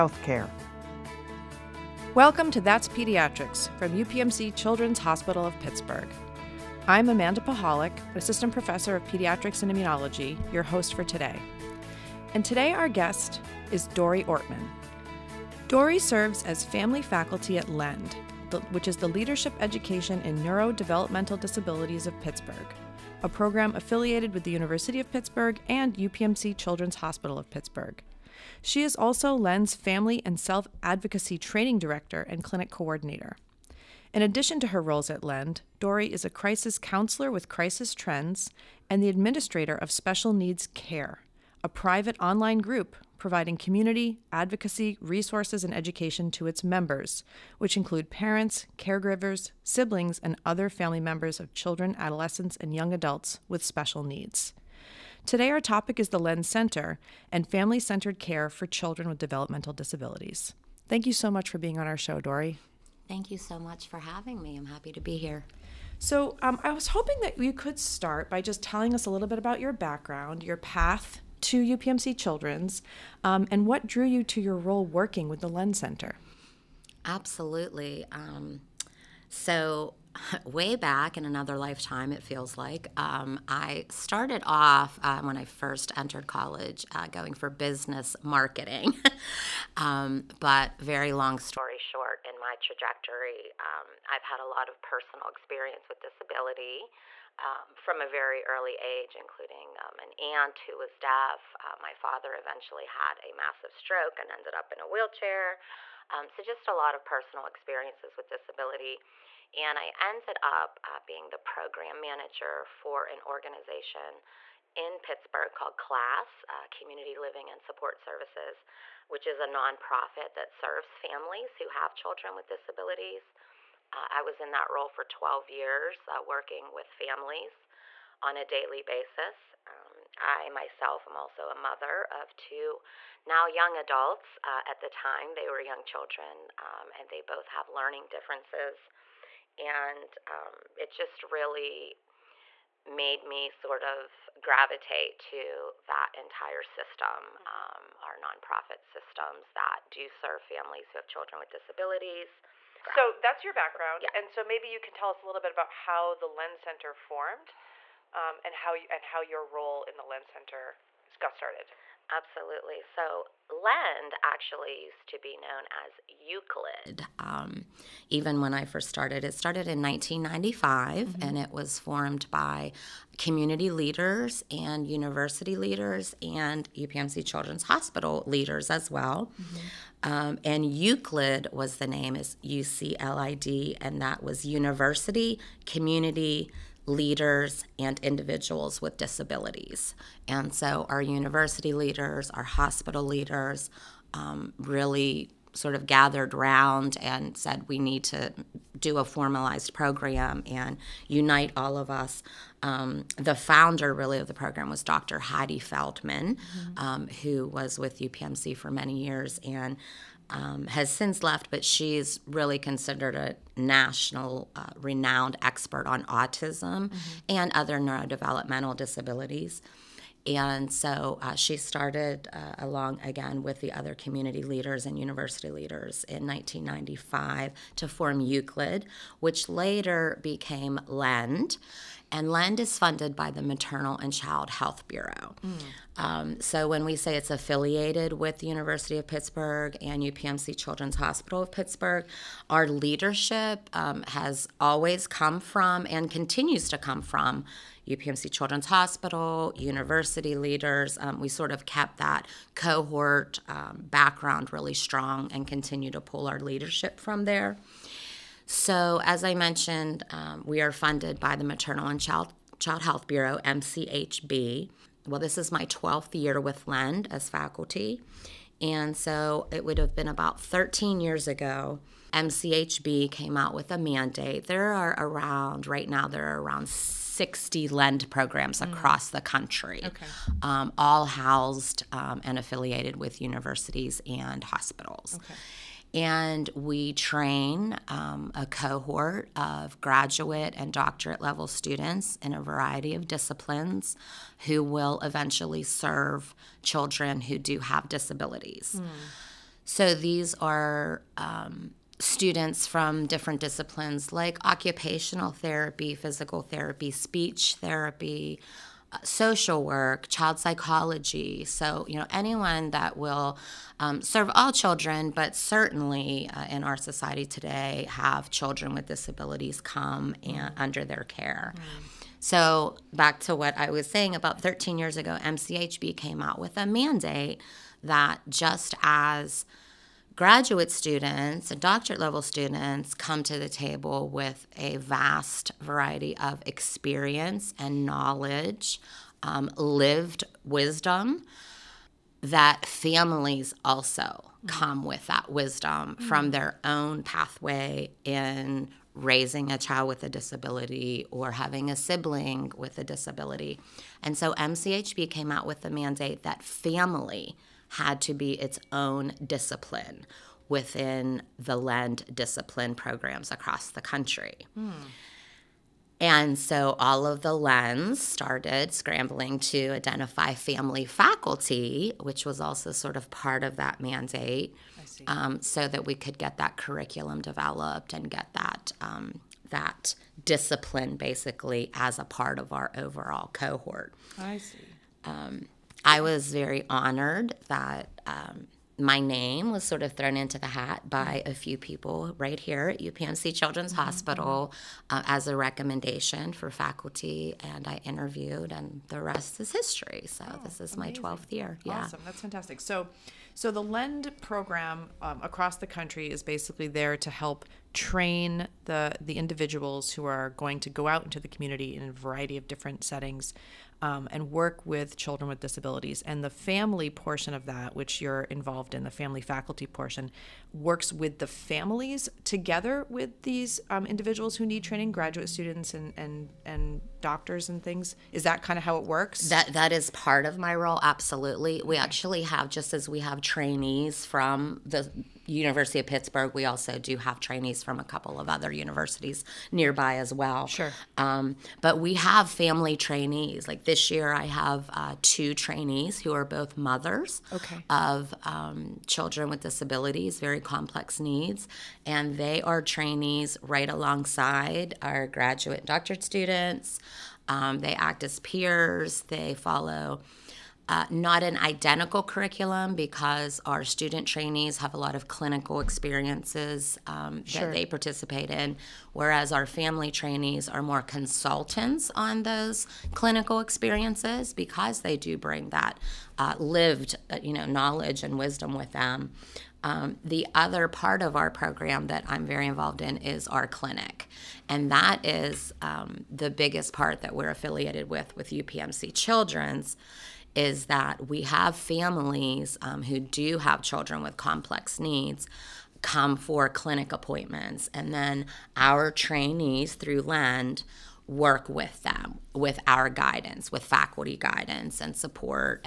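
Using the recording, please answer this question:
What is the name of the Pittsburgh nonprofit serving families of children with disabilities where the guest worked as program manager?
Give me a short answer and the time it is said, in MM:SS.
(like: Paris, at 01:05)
CLASS, at 01:55.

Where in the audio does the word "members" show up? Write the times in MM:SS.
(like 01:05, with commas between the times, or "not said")
00:46, 00:50.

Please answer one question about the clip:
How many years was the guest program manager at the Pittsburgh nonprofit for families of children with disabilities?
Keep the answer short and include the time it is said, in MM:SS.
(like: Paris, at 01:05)
12, at 02:05.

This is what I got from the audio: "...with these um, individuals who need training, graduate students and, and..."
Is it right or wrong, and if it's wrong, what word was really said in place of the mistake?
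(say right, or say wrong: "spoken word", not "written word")
right.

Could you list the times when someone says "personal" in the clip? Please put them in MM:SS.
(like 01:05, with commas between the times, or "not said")
01:34, 01:47.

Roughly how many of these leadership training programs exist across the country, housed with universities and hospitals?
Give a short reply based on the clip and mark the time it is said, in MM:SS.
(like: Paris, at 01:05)
60, at 04:36.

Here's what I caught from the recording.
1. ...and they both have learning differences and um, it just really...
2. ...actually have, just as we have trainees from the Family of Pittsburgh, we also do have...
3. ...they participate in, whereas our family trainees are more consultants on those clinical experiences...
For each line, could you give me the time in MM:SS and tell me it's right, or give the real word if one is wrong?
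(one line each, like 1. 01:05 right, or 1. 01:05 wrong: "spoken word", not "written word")
1. 02:16 right
2. 07:11 wrong: "University", not "Family"
3. 07:47 right.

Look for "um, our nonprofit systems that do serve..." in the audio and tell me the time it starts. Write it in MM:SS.
02:27.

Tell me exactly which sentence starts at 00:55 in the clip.
Today, our topic is the LEND Center and family centered care for children with developmental disabilities.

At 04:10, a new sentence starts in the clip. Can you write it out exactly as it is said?
Um, we sort of kept that cohort um, background really strong and continue to pull our leadership from there.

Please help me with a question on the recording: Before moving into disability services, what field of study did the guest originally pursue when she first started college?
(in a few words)
Business marketing.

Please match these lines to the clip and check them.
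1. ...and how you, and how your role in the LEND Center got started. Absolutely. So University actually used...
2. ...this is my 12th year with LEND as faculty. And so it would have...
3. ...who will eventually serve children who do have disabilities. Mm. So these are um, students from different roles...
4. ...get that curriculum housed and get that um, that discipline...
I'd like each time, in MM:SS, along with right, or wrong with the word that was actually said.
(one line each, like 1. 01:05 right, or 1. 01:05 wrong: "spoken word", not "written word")
1. 02:38 wrong: "LEND", not "University"
2. 04:25 right
3. 04:54 wrong: "disciplines", not "roles"
4. 06:16 wrong: "developed", not "housed".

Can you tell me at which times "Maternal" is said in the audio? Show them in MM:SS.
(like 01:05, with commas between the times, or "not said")
03:53, 04:21.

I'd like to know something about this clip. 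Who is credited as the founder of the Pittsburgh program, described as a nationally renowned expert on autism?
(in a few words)
Dr. Heidi Feldman.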